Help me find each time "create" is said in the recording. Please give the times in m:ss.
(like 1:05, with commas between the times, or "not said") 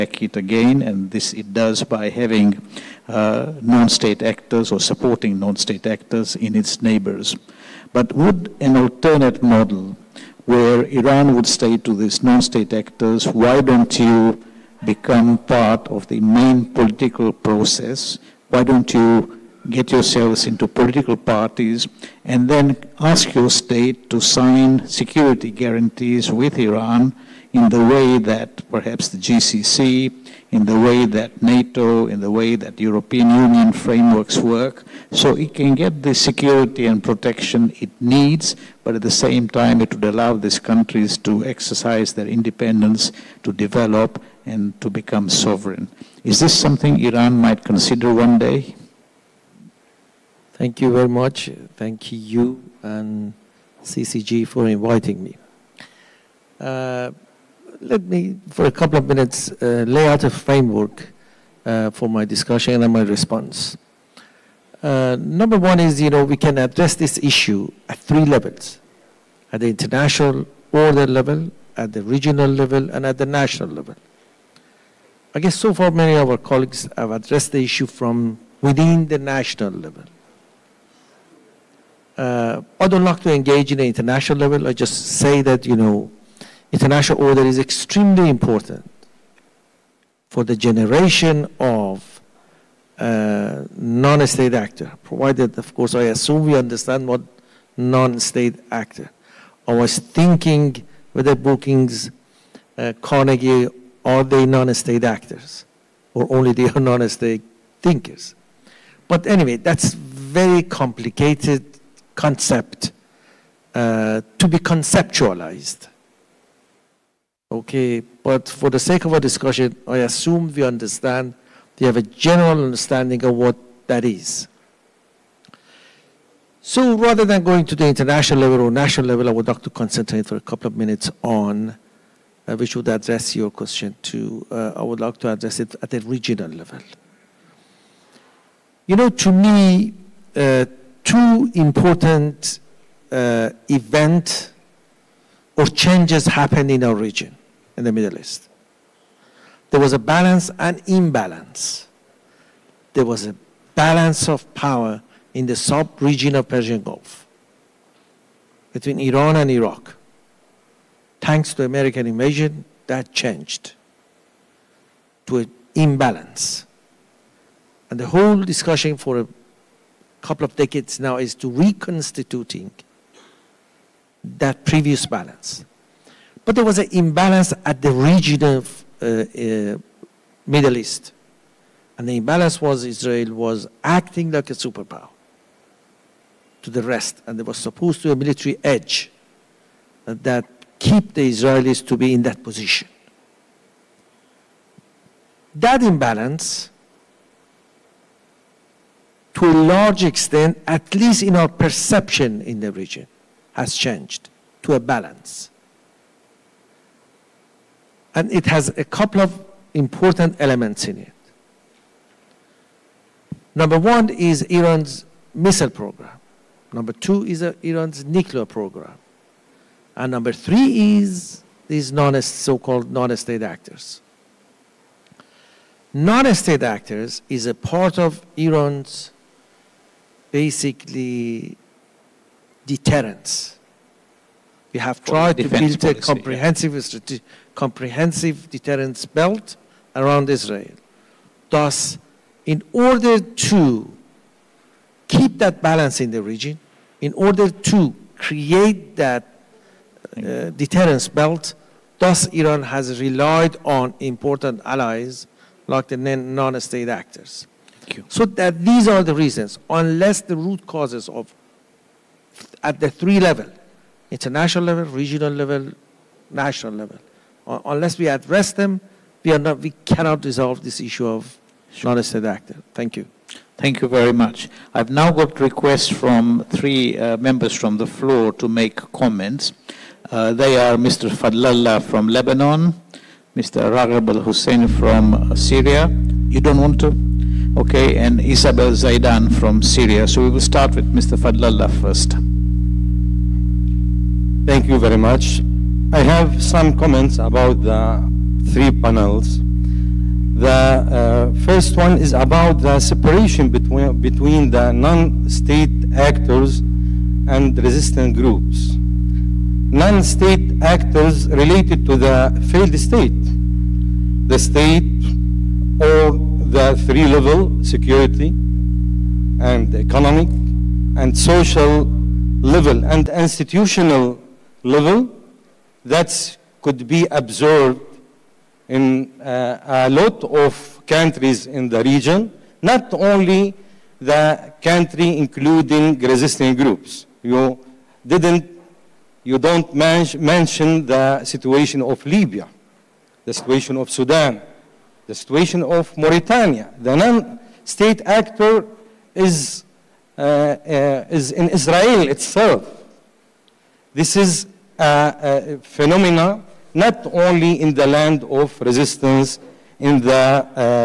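4:08.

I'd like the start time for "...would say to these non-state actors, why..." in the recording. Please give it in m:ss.
0:11.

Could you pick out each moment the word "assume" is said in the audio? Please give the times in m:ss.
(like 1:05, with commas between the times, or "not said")
1:36, 1:59.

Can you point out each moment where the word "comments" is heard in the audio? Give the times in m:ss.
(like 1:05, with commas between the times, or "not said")
4:38, 4:56.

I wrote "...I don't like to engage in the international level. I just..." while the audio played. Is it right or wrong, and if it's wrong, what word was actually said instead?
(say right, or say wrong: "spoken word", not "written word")
right.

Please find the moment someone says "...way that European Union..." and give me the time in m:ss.
0:32.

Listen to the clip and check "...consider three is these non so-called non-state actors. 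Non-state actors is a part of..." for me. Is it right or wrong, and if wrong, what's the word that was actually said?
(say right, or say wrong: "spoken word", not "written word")
wrong: "number", not "consider".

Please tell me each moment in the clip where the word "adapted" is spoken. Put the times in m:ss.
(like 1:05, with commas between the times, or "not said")
not said.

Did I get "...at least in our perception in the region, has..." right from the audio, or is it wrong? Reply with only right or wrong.
right.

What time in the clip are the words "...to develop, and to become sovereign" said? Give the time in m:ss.
0:43.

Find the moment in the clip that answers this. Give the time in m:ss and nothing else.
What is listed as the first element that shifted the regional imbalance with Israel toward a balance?
3:34.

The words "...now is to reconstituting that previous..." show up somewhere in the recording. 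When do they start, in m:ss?
2:50.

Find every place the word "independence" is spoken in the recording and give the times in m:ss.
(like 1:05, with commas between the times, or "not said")
0:42.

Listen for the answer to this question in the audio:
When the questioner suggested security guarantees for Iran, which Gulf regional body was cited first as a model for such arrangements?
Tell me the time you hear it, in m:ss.
0:29.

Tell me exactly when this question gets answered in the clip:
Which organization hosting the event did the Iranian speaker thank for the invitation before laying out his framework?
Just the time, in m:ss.
0:53.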